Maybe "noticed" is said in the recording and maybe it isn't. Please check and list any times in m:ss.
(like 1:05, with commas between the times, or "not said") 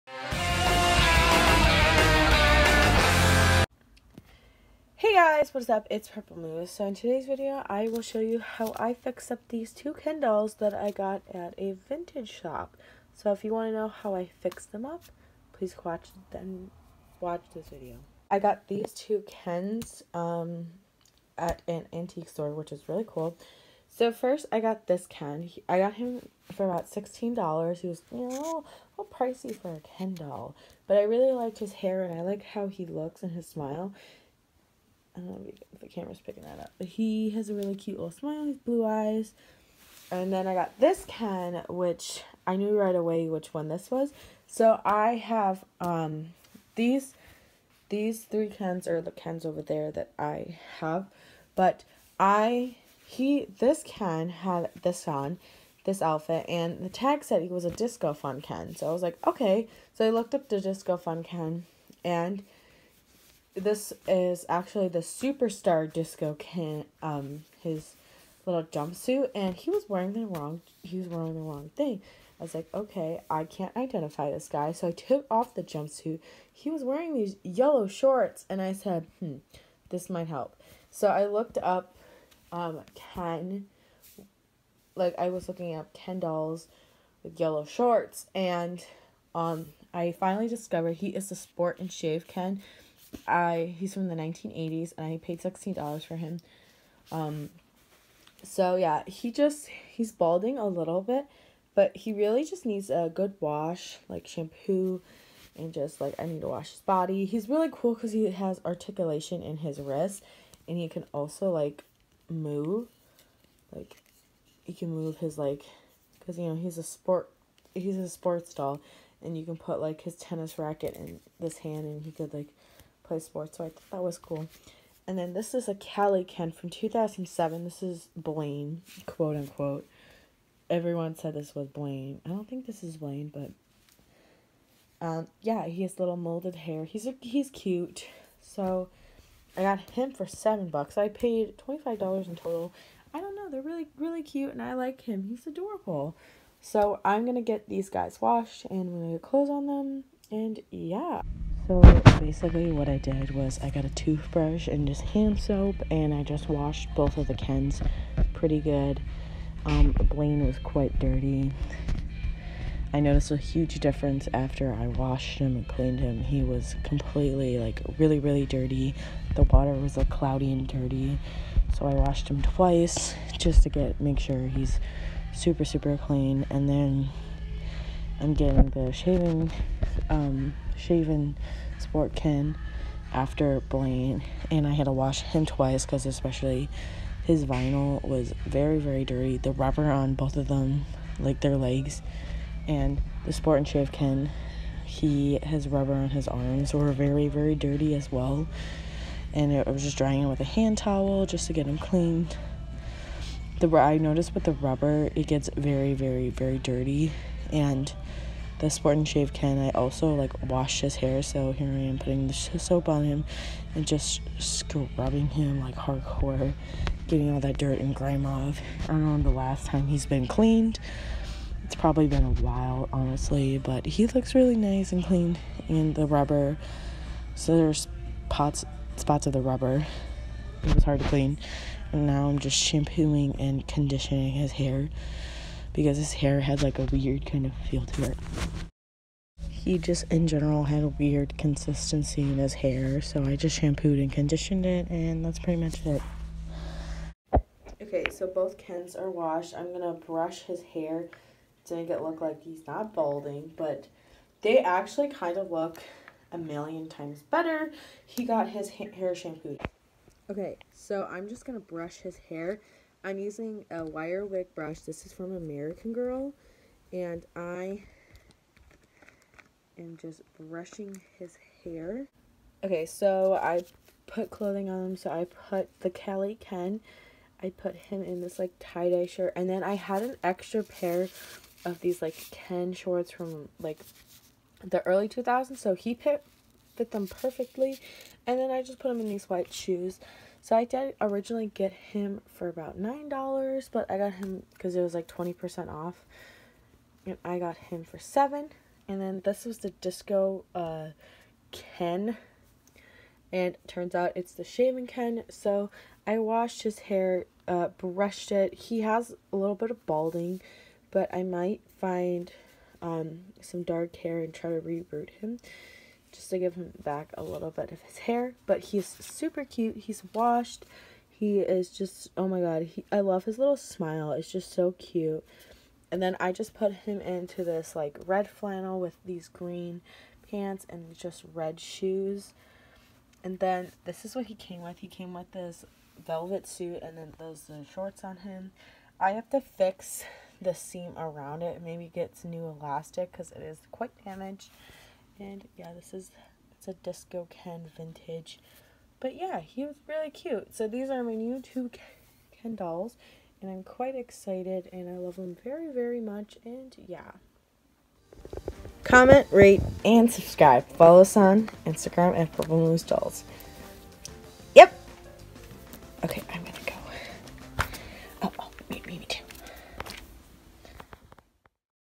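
2:42, 3:23.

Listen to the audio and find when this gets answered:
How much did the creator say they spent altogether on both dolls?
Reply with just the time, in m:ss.
2:21.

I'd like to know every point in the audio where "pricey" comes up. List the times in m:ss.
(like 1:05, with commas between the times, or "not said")
0:29.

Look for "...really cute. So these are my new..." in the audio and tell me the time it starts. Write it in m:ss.
5:49.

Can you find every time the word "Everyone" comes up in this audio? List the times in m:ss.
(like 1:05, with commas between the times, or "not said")
2:10.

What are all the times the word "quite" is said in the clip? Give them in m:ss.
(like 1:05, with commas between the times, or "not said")
2:40, 5:43, 5:53.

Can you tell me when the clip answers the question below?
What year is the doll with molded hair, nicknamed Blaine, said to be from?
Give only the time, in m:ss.
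2:06.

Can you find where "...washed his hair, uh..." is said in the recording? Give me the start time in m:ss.
5:06.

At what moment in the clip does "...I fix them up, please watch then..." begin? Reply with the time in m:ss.
0:14.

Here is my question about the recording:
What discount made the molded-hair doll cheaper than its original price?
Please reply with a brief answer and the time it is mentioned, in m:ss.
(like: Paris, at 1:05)
20%, at 4:55.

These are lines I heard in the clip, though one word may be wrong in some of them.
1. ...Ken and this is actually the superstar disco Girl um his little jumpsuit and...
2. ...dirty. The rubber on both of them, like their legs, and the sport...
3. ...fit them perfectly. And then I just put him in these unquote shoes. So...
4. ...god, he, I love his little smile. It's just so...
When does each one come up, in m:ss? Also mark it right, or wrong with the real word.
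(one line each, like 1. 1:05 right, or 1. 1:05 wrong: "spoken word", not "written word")
1. 1:01 wrong: "Ken", not "Girl"
2. 3:09 right
3. 4:46 wrong: "white", not "unquote"
4. 5:22 right.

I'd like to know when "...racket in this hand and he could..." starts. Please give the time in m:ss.
2:00.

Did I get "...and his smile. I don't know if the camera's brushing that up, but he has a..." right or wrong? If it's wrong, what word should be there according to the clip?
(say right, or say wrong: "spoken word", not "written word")
wrong: "picking", not "brushing".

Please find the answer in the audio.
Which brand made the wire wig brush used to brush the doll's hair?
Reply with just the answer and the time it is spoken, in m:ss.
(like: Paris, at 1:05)
American Girl, at 4:25.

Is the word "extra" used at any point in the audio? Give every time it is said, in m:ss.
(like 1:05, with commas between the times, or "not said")
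4:40.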